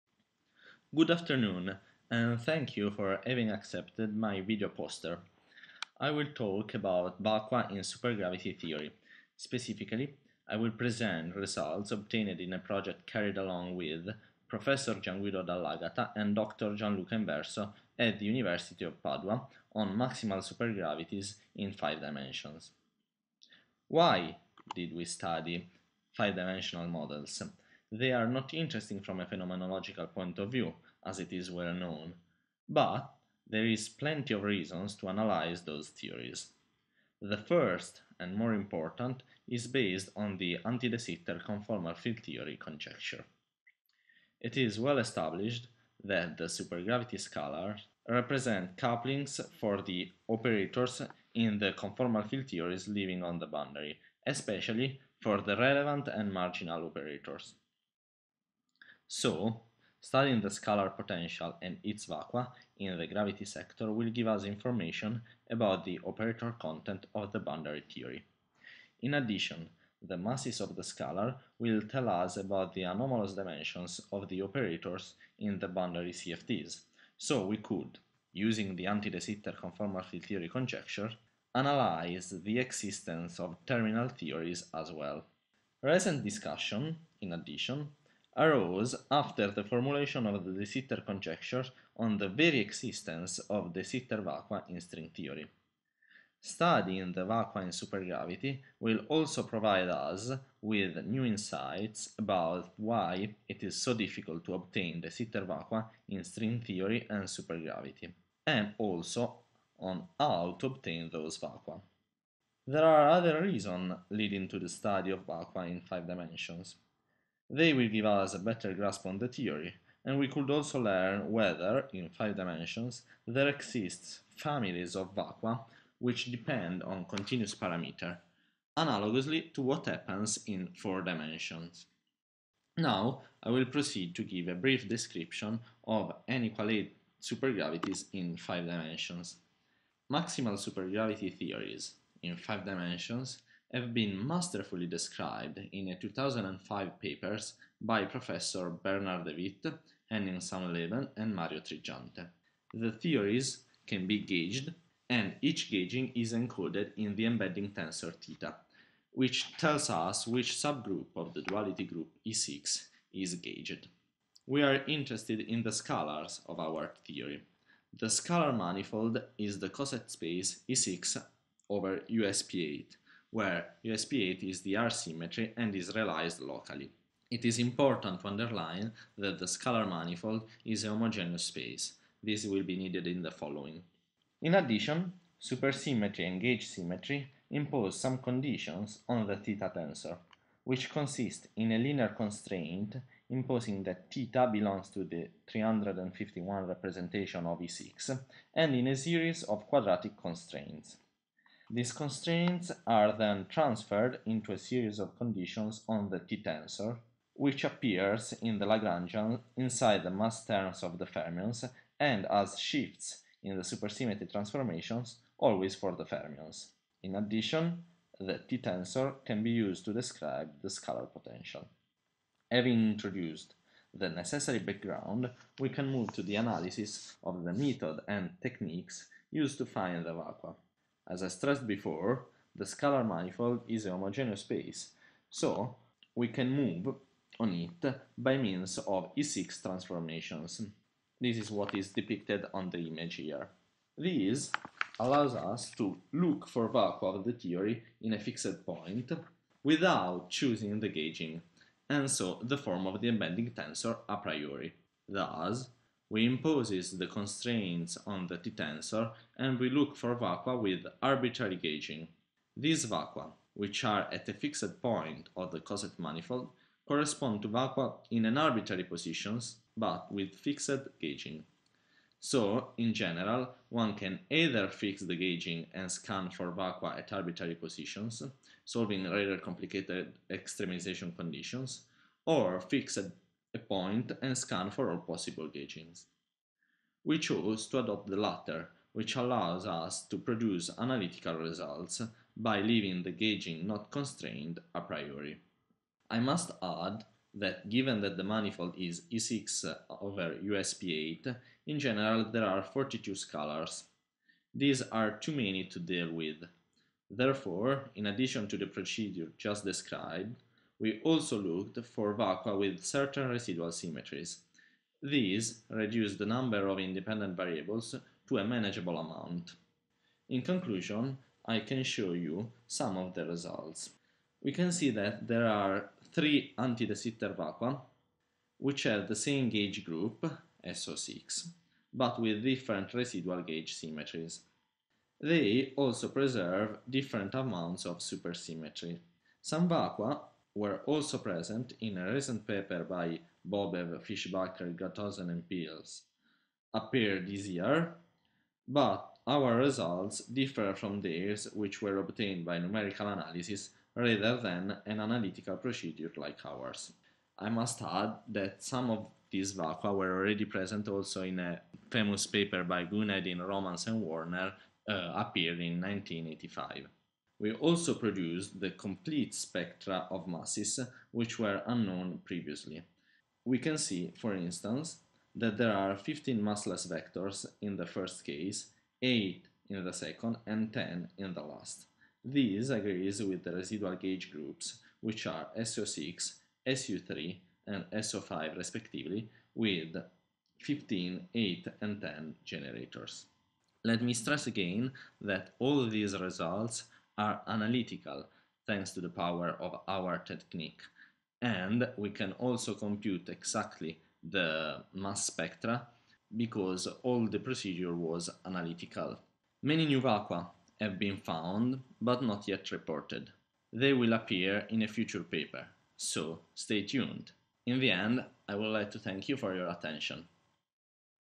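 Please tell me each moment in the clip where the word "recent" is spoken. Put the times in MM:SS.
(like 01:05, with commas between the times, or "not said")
01:25, 05:42.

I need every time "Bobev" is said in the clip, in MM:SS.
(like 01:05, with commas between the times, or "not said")
05:43.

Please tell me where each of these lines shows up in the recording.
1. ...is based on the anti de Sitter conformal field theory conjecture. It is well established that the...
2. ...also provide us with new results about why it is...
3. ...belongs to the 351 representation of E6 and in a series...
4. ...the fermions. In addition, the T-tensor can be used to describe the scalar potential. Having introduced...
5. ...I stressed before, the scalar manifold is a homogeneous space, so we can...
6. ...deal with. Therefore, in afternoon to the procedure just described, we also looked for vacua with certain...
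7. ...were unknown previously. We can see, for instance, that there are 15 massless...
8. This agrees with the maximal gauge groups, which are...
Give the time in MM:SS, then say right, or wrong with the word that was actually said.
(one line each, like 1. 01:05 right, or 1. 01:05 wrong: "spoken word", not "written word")
1. 00:39 right
2. 01:39 wrong: "insights", not "results"
3. 03:14 right
4. 03:35 right
5. 03:51 right
6. 05:05 wrong: "addition", not "afternoon"
7. 06:11 right
8. 06:22 wrong: "residual", not "maximal".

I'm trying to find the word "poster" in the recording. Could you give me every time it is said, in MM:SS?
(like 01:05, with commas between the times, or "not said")
00:04.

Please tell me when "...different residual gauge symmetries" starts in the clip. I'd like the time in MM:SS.
05:32.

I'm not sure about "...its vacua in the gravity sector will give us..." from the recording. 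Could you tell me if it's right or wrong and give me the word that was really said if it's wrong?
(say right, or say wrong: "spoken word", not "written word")
right.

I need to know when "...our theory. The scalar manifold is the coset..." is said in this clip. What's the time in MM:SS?
02:46.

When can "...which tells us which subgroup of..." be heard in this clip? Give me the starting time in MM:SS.
02:39.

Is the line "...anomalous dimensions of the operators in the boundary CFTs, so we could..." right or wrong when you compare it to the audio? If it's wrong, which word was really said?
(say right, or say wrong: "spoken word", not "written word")
right.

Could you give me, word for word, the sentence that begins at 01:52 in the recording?
There are other reasons leading to the study of vacua in five dimensions.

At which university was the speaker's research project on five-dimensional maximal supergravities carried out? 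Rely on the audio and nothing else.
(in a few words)
University of Padua.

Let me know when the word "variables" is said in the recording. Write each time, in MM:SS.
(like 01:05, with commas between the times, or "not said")
05:17.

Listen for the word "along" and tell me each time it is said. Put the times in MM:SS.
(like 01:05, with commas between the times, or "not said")
00:13.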